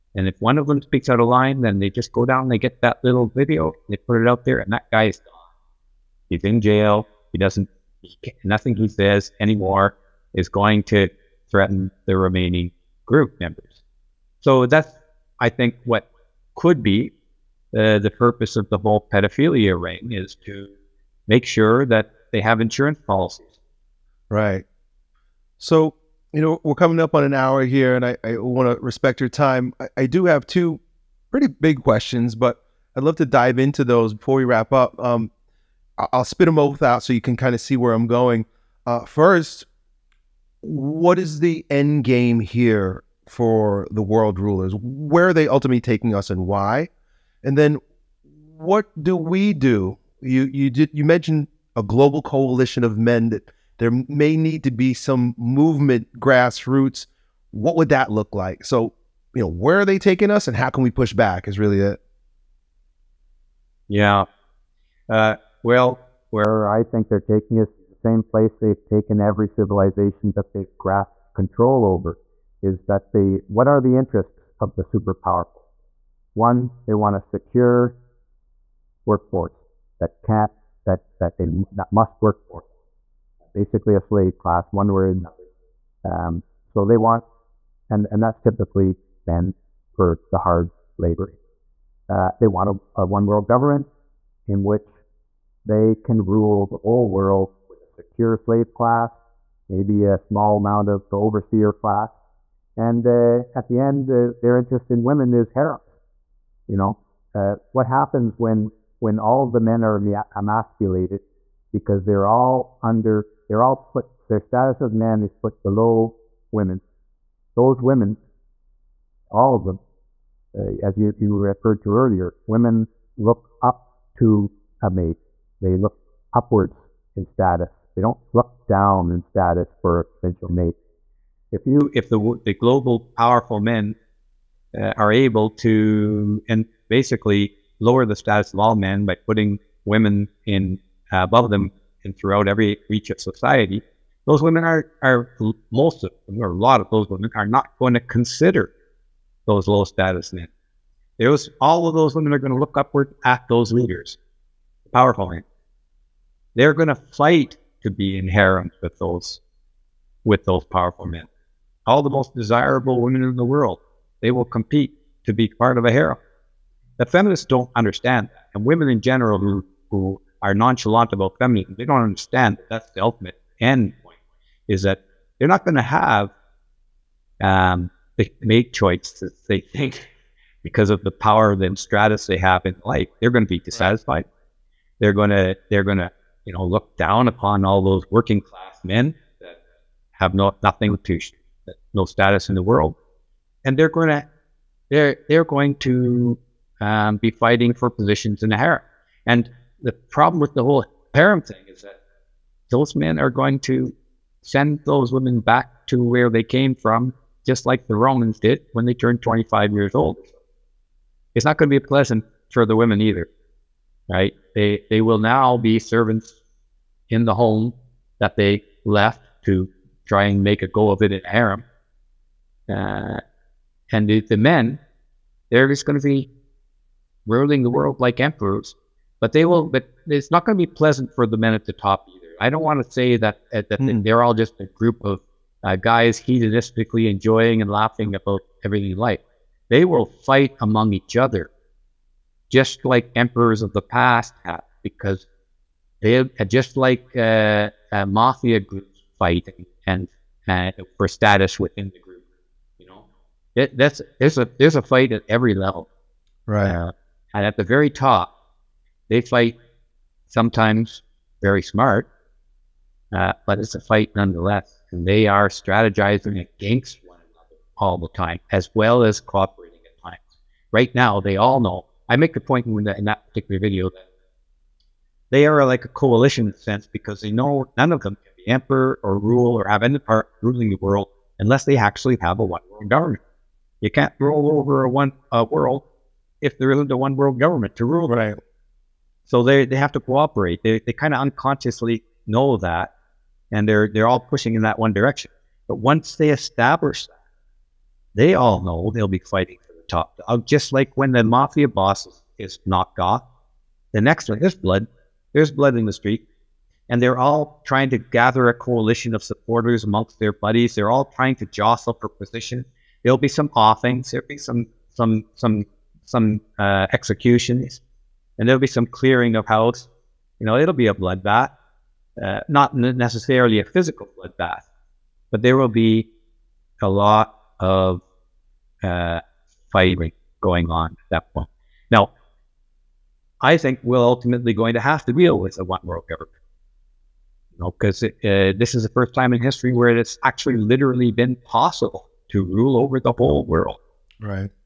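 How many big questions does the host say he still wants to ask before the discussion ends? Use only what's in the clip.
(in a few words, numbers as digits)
2.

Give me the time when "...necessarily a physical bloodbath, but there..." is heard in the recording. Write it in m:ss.
5:22.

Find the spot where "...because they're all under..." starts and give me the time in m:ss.
1:51.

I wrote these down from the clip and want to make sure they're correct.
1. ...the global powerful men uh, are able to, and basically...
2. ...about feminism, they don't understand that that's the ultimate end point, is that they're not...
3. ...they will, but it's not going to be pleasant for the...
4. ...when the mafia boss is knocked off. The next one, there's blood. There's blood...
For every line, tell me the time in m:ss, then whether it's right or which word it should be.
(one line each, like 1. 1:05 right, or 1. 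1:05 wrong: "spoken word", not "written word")
1. 2:12 right
2. 2:51 right
3. 3:49 right
4. 5:00 right.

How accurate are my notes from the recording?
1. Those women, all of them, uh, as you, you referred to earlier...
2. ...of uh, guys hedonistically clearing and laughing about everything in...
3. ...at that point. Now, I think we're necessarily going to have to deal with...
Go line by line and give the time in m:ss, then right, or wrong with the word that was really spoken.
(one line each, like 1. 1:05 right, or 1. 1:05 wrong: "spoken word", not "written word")
1. 1:57 right
2. 3:55 wrong: "enjoying", not "clearing"
3. 5:30 wrong: "ultimately", not "necessarily".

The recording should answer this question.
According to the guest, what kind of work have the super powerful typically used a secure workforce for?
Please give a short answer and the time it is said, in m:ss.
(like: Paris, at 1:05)
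hard labor, at 1:30.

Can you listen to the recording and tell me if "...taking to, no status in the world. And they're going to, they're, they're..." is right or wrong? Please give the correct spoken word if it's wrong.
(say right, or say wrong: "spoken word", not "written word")
wrong: "nothing", not "taking".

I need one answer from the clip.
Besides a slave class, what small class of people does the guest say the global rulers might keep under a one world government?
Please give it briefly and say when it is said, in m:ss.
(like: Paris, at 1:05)
overseer class, at 1:41.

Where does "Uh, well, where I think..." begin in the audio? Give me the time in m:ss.
1:05.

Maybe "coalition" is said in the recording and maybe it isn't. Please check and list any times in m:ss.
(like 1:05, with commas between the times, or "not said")
0:52, 4:35, 5:08.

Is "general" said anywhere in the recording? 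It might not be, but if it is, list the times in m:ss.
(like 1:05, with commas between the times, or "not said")
2:49.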